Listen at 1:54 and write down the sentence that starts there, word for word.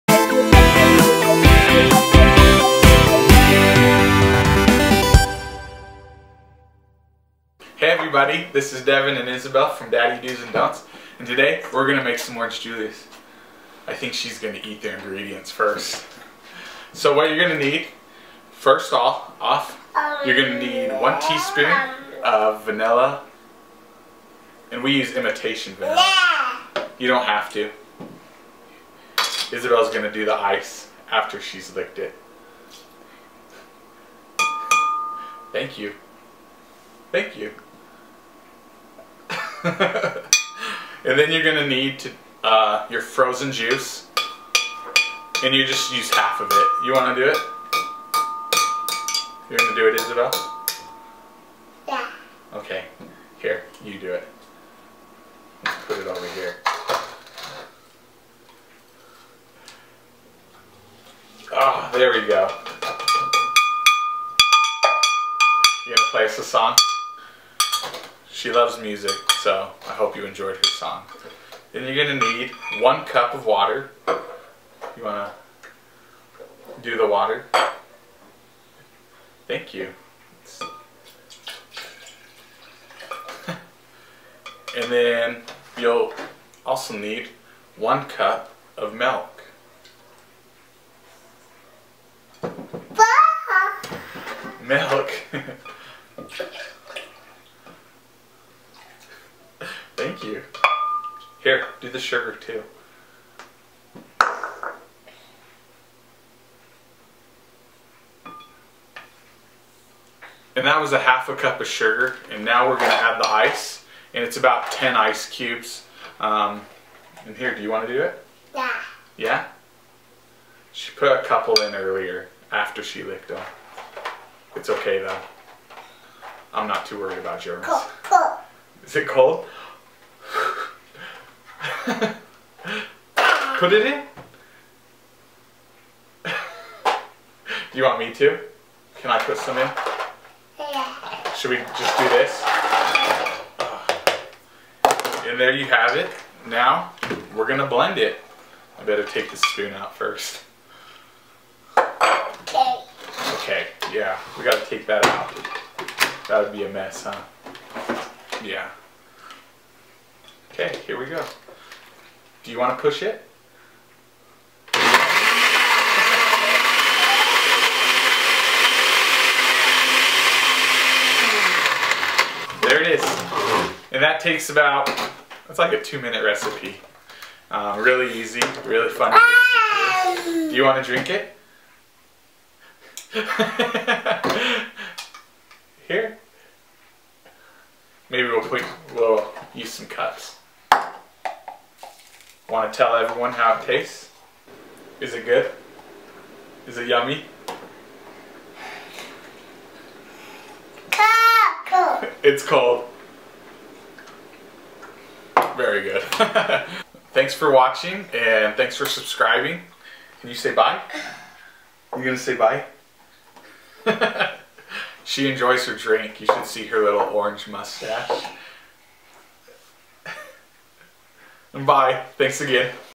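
And it's about 10 ice cubes.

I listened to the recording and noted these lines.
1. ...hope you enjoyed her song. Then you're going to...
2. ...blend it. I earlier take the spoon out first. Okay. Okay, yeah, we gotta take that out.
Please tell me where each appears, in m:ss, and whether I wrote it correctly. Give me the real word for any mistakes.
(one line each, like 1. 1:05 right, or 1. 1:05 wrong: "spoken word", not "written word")
1. 1:09 right
2. 2:27 wrong: "better", not "earlier".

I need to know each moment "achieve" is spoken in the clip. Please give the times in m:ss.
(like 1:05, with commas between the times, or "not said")
not said.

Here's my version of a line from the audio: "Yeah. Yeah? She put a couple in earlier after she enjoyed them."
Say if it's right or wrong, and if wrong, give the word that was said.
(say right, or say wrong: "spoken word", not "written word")
wrong: "licked", not "enjoyed".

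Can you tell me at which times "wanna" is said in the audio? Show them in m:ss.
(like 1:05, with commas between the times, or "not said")
0:46, 1:57.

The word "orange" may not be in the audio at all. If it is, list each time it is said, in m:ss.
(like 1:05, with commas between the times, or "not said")
0:12, 3:36.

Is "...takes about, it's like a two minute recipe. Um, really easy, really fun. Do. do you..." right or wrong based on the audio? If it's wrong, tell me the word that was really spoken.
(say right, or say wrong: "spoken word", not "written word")
right.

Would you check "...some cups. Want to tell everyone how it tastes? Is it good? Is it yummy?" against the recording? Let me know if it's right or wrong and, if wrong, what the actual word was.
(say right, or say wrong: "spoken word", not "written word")
right.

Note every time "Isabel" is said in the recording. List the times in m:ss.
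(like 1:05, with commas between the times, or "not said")
0:09, 0:29, 0:50.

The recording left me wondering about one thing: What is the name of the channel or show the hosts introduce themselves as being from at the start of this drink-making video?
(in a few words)
Daddy Do's and Don'ts.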